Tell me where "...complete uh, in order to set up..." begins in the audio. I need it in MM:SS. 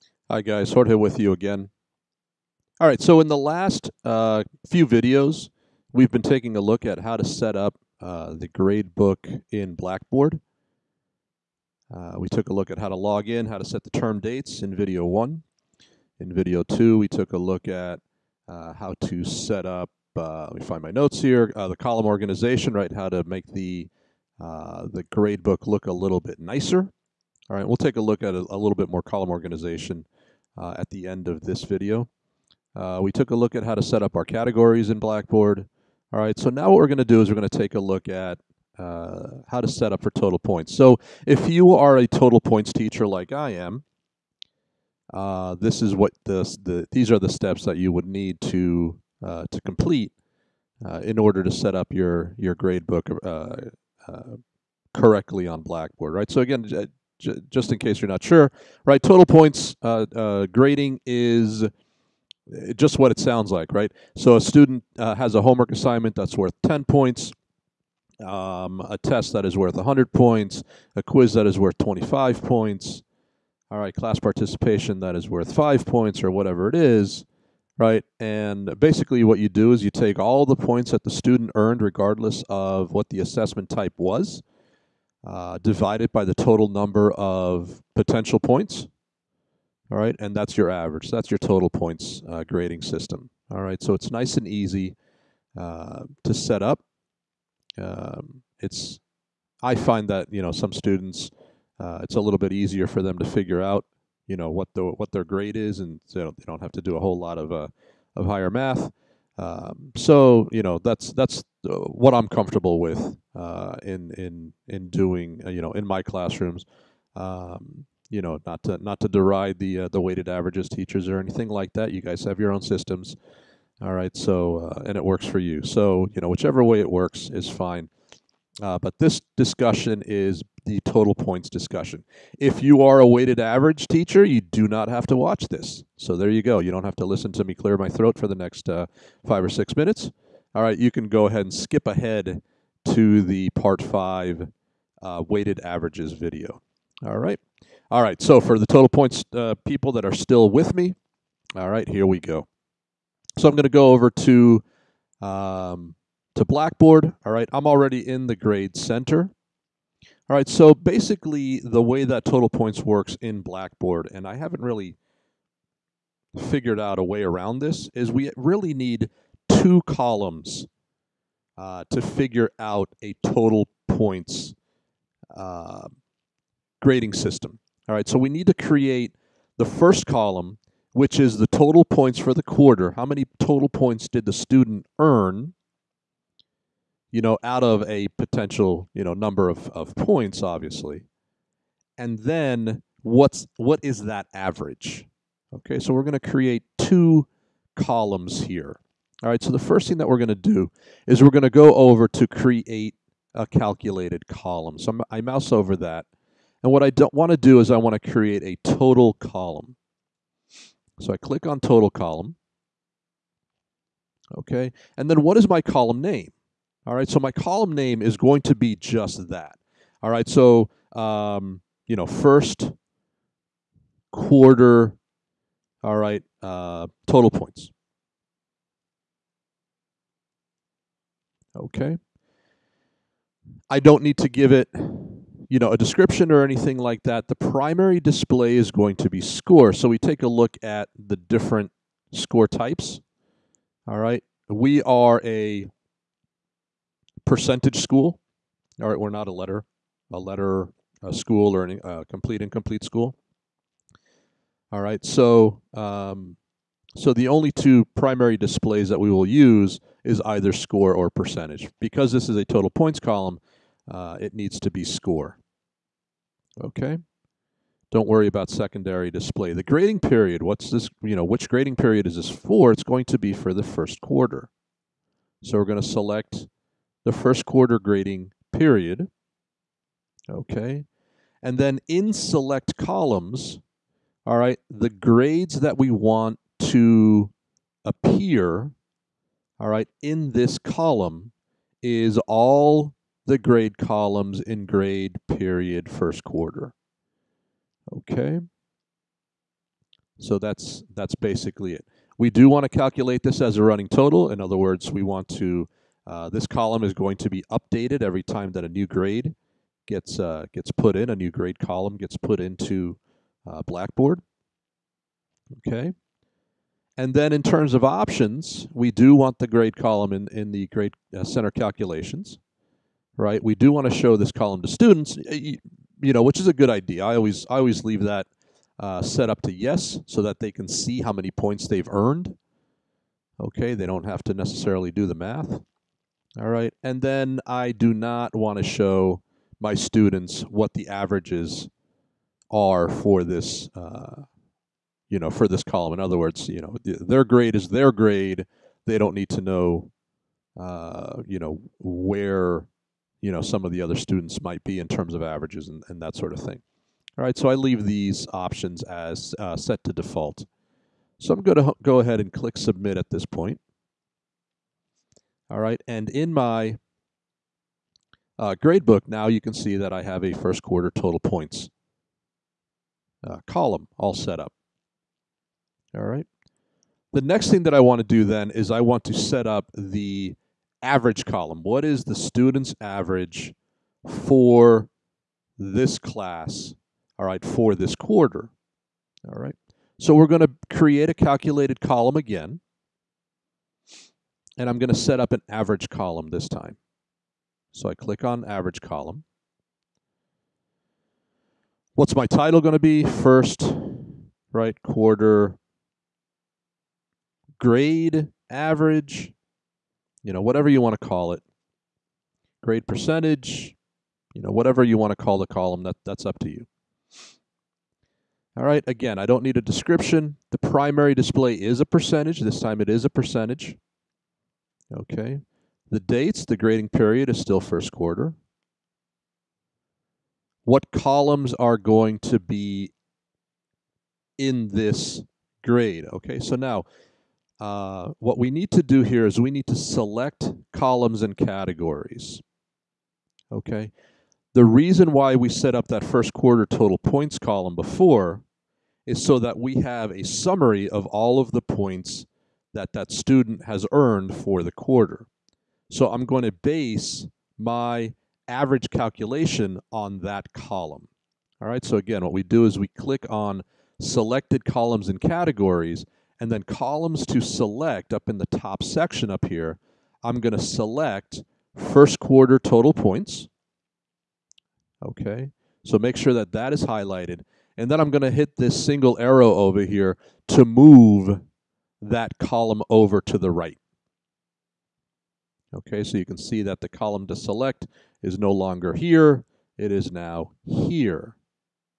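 00:49.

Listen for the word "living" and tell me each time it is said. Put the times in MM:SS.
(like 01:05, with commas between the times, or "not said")
not said.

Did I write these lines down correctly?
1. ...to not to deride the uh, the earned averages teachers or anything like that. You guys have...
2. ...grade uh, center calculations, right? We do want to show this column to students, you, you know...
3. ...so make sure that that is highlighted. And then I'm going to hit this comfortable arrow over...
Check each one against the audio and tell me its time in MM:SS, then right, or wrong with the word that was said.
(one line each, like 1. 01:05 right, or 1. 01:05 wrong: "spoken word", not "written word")
1. 01:58 wrong: "weighted", not "earned"
2. 05:20 right
3. 07:55 wrong: "single", not "comfortable".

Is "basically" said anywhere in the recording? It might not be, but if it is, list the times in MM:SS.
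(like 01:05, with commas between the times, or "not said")
01:18, 02:40, 05:01.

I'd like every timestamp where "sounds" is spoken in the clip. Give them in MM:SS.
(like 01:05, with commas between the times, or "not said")
01:03.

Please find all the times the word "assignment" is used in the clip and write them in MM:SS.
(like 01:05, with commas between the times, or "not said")
01:05.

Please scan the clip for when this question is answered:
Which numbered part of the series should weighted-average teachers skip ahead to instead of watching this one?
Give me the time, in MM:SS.
02:23.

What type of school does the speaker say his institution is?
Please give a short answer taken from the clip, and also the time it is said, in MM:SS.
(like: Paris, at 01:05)
a percentage school, at 04:07.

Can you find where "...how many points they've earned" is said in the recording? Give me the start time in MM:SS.
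05:30.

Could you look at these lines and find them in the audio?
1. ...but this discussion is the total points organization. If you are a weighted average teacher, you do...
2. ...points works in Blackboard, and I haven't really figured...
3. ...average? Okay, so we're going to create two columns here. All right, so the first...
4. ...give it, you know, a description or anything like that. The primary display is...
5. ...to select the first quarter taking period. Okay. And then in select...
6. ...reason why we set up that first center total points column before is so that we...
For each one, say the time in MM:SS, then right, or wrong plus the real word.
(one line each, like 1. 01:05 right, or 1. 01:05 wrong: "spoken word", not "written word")
1. 02:08 wrong: "discussion", not "organization"
2. 02:42 right
3. 03:14 right
4. 03:54 right
5. 04:35 wrong: "grading", not "taking"
6. 07:24 wrong: "quarter", not "center".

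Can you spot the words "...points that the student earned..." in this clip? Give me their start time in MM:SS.
01:20.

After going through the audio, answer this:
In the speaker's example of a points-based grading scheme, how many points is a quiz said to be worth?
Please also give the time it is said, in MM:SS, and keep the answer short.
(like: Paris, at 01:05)
25, at 01:11.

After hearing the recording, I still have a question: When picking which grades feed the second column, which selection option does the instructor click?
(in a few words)
selected columns and categories.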